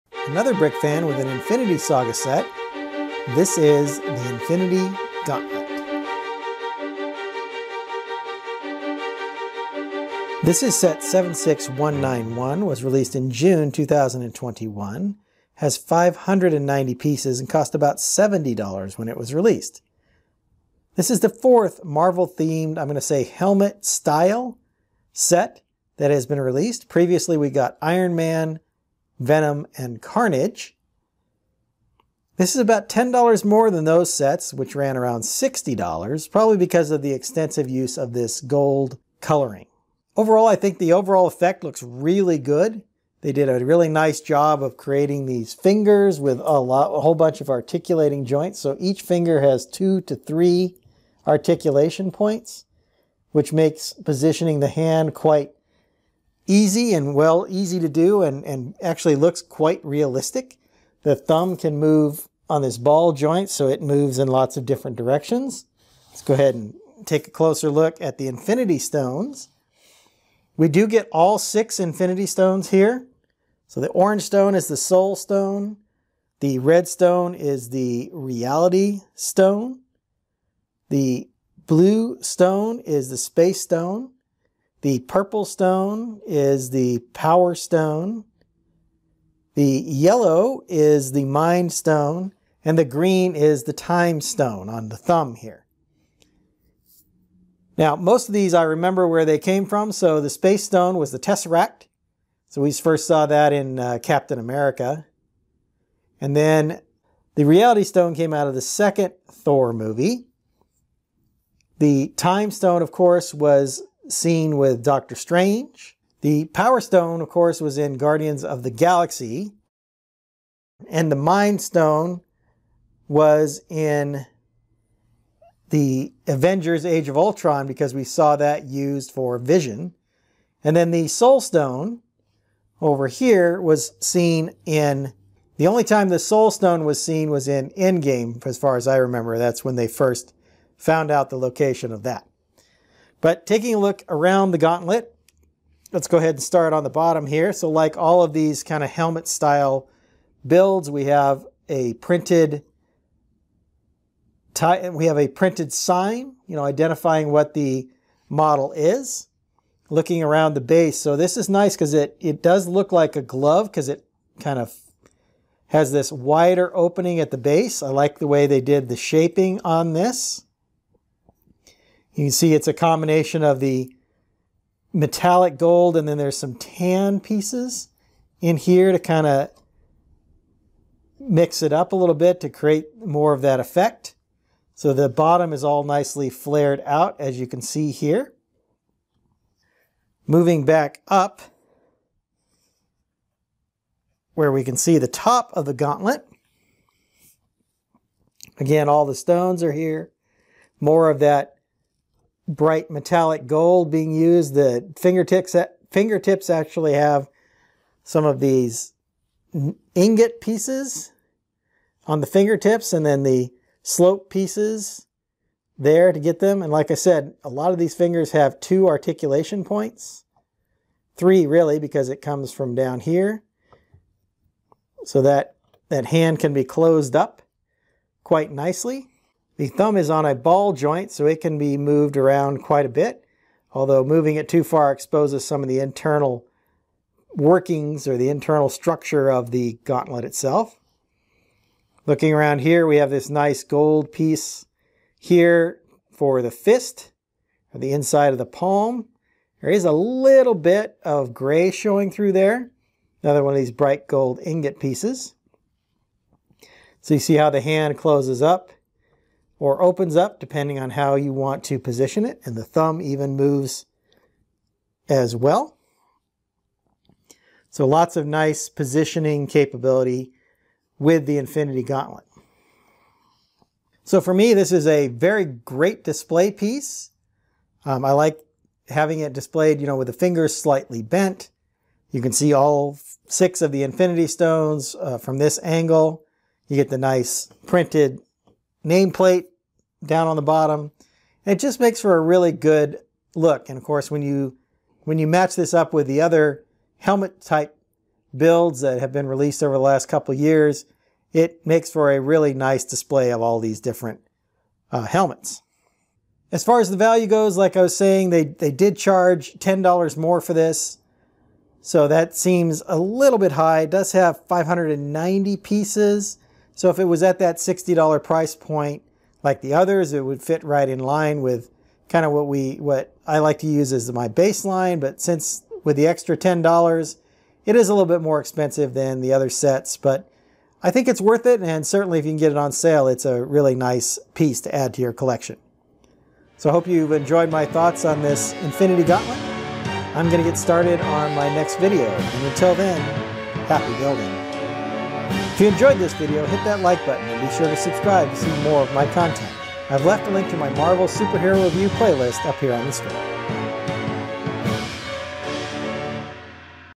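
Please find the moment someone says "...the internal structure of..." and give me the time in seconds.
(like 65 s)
238 s.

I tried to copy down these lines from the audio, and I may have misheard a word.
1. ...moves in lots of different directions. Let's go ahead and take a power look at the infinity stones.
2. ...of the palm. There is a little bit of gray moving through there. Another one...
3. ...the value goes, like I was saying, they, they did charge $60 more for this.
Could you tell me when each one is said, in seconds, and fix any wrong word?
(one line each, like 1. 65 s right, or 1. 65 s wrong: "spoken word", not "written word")
1. 63 s wrong: "closer", not "power"
2. 248 s wrong: "showing", not "moving"
3. 306 s wrong: "10", not "60".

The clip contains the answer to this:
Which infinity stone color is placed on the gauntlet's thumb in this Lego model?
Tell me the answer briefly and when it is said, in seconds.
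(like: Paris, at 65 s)
Green, at 92 s.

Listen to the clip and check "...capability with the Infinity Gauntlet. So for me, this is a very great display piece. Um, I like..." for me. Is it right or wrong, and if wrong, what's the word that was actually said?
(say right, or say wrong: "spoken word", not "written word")
right.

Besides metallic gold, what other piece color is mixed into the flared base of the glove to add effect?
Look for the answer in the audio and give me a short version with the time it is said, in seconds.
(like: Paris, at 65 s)
Tan, at 176 s.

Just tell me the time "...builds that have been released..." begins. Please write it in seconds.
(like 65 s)
298 s.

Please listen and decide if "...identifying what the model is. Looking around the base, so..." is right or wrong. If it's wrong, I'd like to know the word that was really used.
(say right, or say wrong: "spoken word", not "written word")
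right.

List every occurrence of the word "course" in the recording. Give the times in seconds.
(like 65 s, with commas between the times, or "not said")
112 s, 117 s, 293 s.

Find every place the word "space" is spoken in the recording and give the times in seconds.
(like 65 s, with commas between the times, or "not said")
83 s, 100 s.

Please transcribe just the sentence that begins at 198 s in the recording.
Again, all the stones are here.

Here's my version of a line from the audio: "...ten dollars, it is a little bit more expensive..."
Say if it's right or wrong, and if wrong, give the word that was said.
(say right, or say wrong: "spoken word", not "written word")
right.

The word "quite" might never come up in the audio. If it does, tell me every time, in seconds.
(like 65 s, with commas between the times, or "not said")
55 s, 59 s, 228 s, 232 s.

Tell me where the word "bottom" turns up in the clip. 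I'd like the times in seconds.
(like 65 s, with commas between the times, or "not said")
146 s, 185 s, 290 s.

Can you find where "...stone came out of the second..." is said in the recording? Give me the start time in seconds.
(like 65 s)
107 s.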